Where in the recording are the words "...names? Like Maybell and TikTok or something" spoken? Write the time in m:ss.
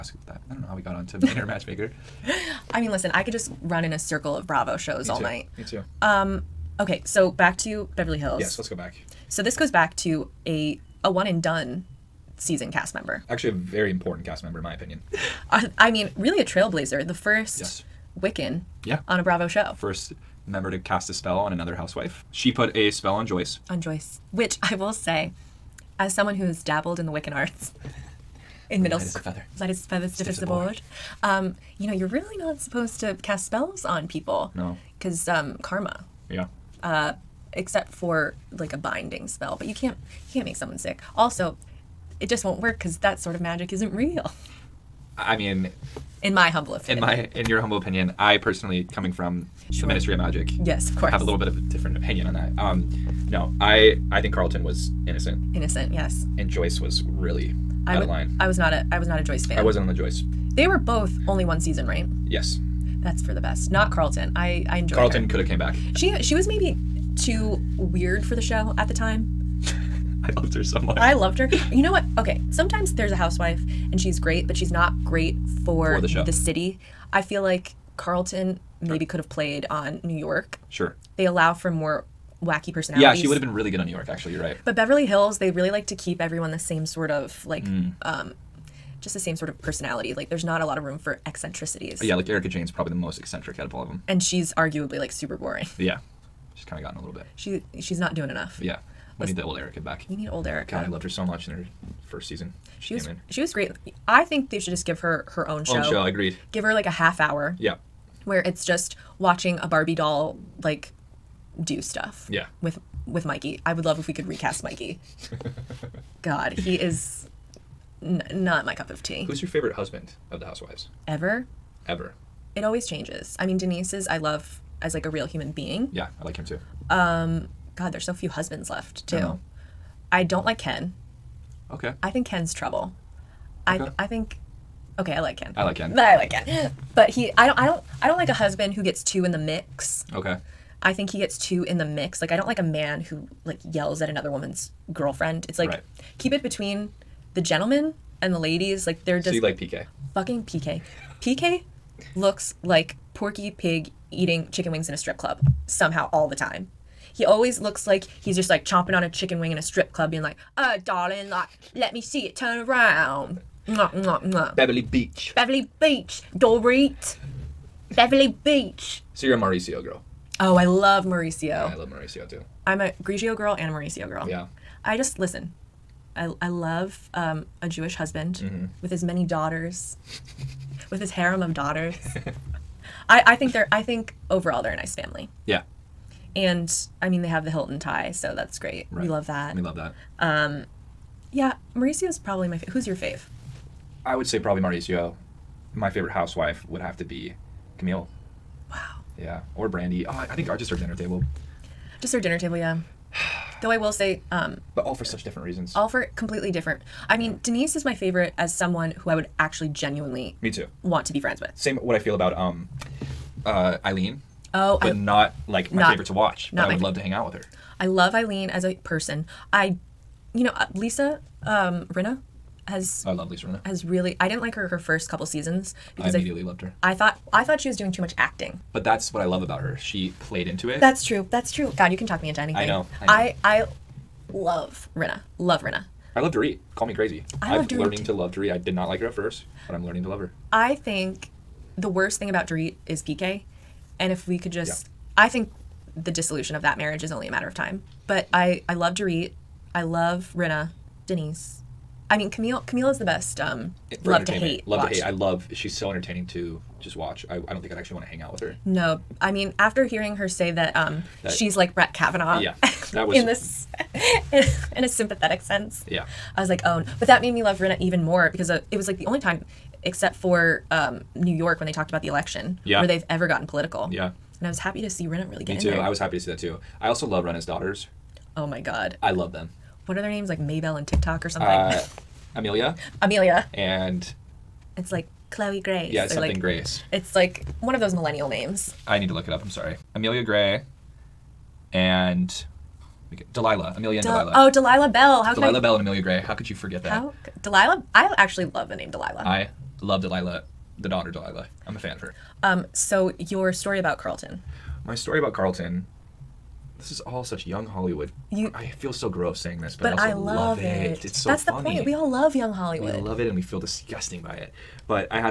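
4:40.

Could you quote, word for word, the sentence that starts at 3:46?
I thought I thought she was doing too much acting.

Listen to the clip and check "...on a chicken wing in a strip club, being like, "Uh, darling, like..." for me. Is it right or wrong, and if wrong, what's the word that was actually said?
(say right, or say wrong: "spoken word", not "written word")
right.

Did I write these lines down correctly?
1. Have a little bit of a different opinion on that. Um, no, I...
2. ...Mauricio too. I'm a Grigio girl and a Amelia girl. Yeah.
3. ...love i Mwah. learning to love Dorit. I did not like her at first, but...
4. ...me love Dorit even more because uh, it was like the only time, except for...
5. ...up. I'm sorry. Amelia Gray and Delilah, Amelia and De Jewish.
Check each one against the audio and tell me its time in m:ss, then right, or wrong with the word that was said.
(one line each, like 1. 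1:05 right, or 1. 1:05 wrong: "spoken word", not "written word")
1. 0:51 right
2. 2:51 wrong: "Mauricio", not "Amelia"
3. 3:57 wrong: "Dorit", not "Mwah"
4. 4:27 wrong: "Rinna", not "Dorit"
5. 4:49 wrong: "Delilah", not "Jewish".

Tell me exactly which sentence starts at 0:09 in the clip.
So this goes back to a a one and done season cast member.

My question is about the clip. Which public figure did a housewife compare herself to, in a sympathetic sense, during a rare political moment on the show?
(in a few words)
Brett Kavanaugh.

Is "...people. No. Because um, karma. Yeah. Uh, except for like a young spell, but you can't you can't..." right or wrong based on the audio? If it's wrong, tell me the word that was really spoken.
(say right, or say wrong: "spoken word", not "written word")
wrong: "binding", not "young".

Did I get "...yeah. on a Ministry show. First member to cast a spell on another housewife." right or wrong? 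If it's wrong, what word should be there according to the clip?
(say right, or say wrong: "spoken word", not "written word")
wrong: "Bravo", not "Ministry".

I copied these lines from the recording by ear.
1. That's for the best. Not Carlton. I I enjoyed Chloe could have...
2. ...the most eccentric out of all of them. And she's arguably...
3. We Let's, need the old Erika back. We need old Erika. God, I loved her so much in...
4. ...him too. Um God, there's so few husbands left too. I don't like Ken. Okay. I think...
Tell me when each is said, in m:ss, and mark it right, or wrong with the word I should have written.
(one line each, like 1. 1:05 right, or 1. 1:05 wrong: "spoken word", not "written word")
1. 1:03 wrong: "Carlton", not "Chloe"
2. 1:32 right
3. 1:39 right
4. 2:06 right.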